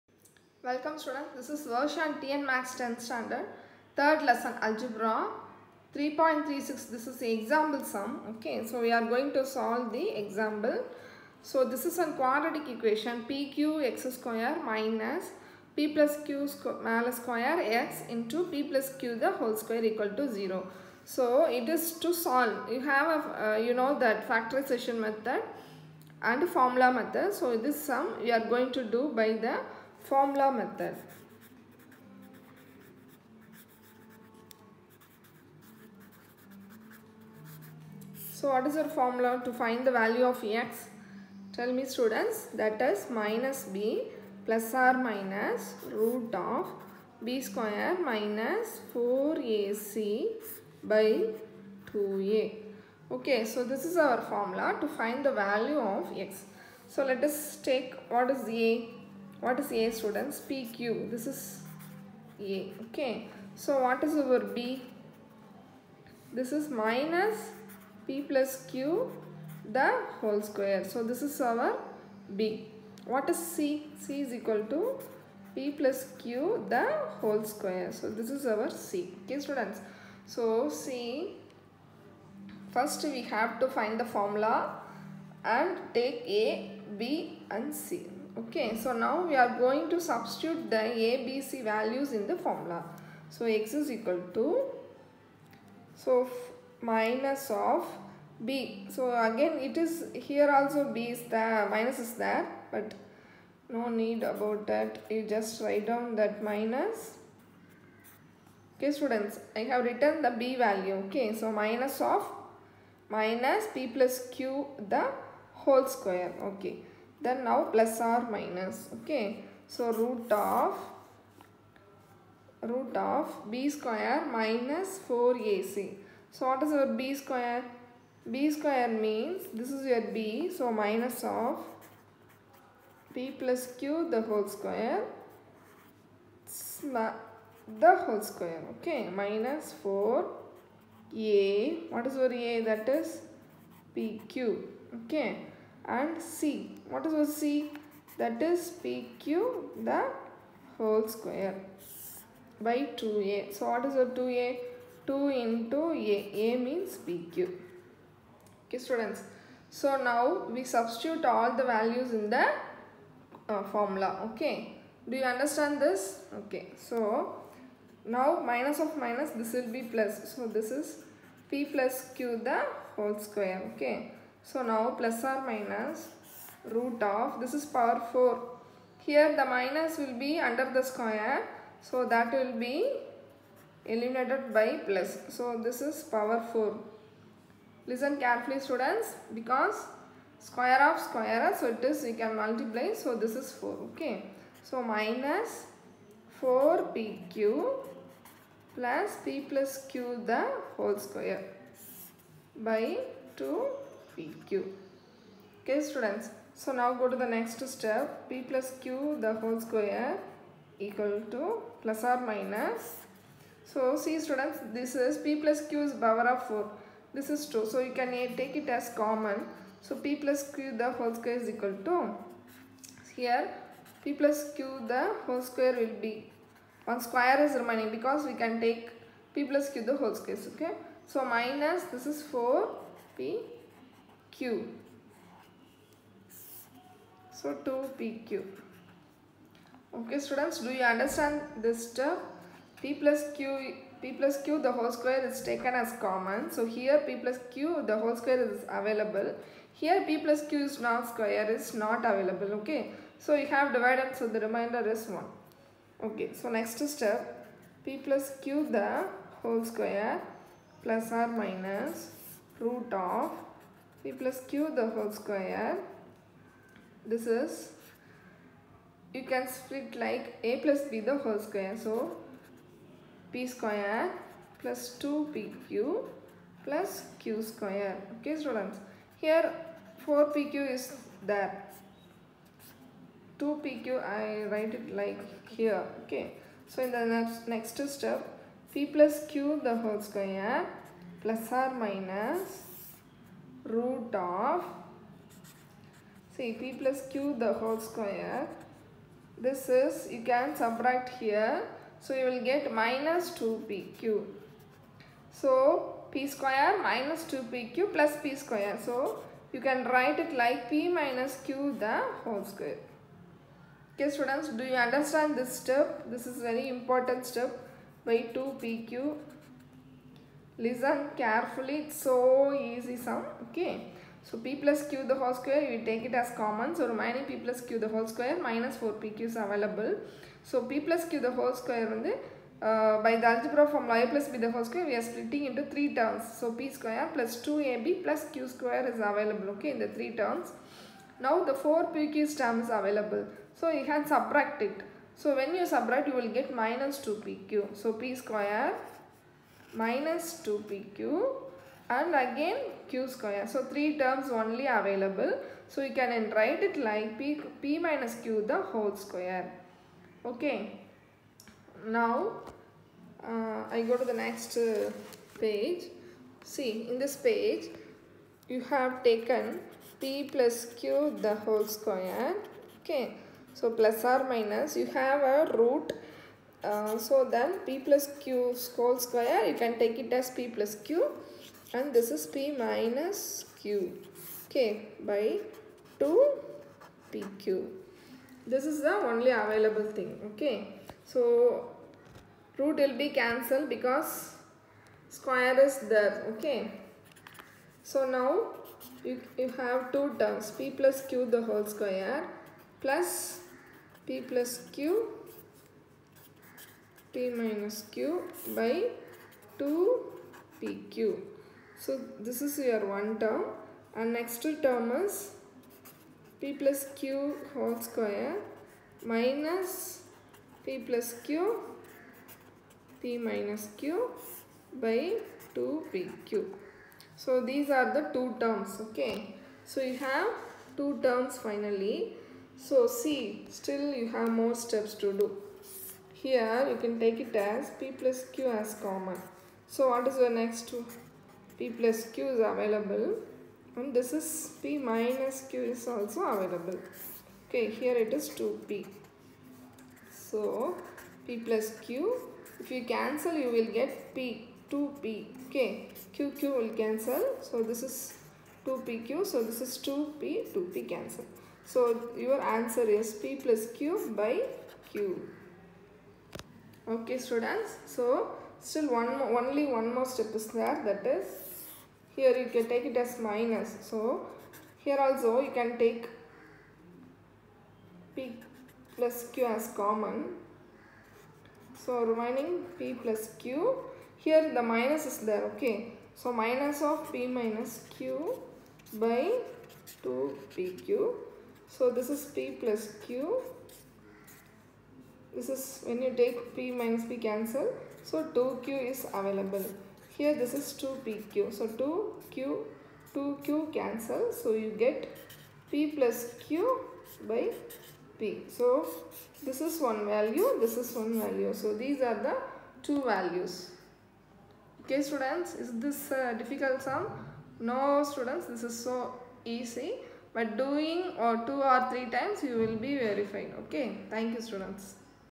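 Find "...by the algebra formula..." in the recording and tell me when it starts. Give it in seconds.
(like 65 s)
333 s.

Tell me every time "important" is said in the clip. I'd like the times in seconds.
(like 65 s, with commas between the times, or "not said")
316 s.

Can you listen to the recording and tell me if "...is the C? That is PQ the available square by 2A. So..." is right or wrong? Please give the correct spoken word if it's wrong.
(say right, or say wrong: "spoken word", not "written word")
wrong: "whole", not "available".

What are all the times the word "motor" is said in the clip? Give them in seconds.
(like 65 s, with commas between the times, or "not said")
not said.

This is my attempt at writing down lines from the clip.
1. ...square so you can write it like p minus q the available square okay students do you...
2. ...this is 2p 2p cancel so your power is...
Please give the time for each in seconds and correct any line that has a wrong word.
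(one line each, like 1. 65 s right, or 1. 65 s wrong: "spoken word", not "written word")
1. 308 s wrong: "whole", not "available"
2. 459 s wrong: "answer", not "power".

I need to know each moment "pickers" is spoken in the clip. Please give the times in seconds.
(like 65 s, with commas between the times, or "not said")
not said.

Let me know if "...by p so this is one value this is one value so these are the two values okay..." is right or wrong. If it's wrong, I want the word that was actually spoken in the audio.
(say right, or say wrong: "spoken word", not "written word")
right.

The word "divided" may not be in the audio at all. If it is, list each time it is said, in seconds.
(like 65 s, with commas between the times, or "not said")
253 s.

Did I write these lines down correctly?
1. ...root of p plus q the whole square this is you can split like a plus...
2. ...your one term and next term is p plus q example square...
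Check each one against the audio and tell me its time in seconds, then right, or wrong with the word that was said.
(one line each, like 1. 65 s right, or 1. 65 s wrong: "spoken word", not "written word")
1. 262 s right
2. 412 s wrong: "whole", not "example".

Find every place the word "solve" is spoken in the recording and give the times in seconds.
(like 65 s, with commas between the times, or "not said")
9 s, 22 s.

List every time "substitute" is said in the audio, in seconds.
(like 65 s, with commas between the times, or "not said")
90 s, 160 s.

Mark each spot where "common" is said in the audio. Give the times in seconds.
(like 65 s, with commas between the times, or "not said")
219 s, 245 s, 326 s, 438 s, 479 s.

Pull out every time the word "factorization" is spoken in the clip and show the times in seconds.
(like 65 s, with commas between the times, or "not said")
24 s.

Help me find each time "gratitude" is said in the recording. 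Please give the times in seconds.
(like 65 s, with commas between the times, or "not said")
not said.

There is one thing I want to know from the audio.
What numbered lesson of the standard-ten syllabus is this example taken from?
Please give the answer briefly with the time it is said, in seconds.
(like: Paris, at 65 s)
third lesson, at 3 s.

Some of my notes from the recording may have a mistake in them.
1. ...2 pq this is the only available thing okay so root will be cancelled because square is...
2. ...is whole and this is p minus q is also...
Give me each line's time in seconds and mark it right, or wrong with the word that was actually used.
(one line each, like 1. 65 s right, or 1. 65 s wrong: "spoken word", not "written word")
1. 385 s right
2. 442 s wrong: "available", not "whole".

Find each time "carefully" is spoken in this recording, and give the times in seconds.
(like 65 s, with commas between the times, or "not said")
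188 s, 321 s.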